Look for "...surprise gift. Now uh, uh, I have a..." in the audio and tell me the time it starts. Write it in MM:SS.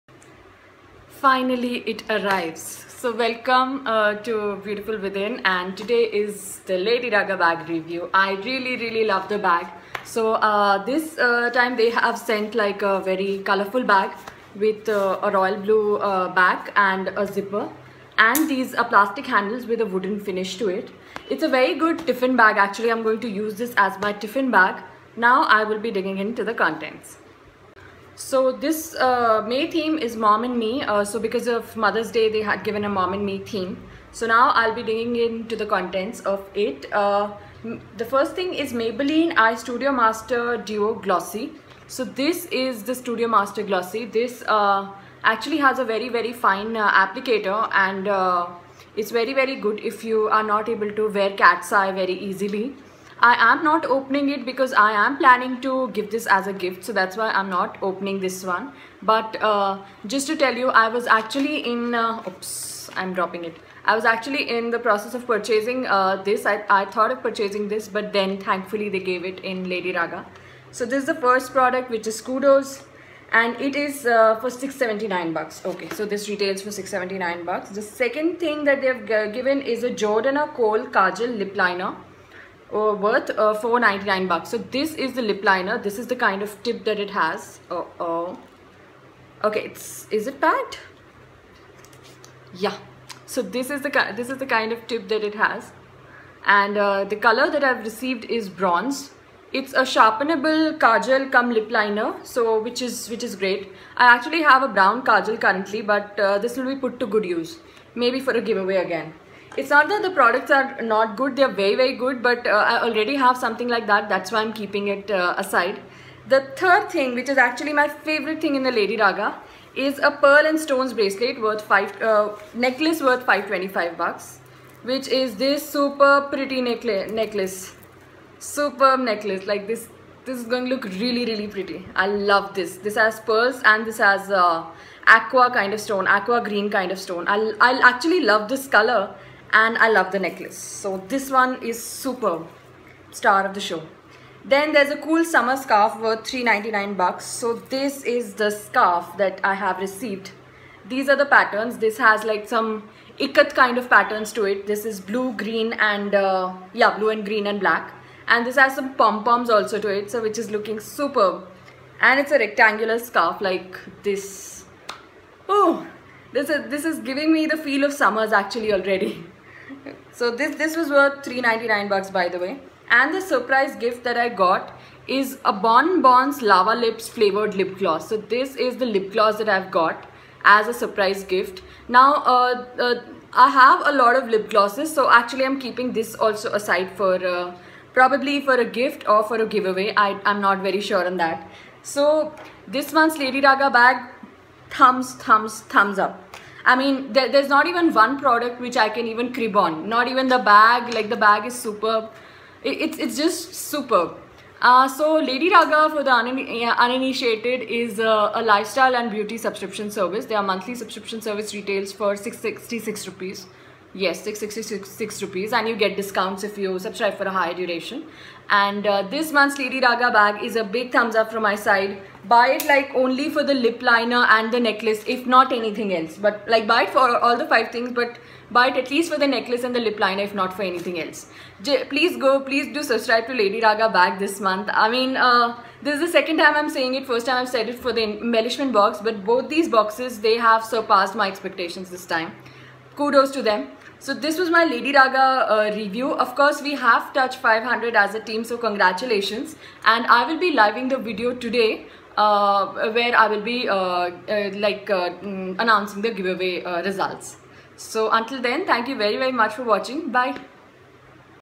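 03:00.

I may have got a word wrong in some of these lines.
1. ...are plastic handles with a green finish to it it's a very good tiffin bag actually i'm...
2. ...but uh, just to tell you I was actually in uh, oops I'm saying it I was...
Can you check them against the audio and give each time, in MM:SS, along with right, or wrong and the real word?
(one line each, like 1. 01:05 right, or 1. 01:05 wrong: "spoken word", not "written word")
1. 00:18 wrong: "wooden", not "green"
2. 00:59 wrong: "dropping", not "saying".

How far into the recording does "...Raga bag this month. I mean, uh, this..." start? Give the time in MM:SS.
03:53.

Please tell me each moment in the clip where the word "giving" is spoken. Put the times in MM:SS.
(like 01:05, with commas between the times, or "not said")
02:46.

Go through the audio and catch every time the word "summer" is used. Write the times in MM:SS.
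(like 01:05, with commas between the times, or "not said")
02:25, 02:47.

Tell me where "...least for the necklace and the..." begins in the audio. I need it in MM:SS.
03:48.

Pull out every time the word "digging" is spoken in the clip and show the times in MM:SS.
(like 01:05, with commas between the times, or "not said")
00:25, 00:34.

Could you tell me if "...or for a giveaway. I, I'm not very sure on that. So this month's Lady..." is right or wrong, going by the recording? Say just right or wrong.
right.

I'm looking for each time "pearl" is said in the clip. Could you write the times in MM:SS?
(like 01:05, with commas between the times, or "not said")
02:00, 02:13.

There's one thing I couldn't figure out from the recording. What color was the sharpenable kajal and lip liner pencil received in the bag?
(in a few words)
Bronze.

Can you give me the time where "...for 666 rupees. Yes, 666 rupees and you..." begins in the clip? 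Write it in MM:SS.
03:31.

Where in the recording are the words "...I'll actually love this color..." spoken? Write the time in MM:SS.
02:17.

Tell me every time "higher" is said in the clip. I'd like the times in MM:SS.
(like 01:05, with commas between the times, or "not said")
03:37.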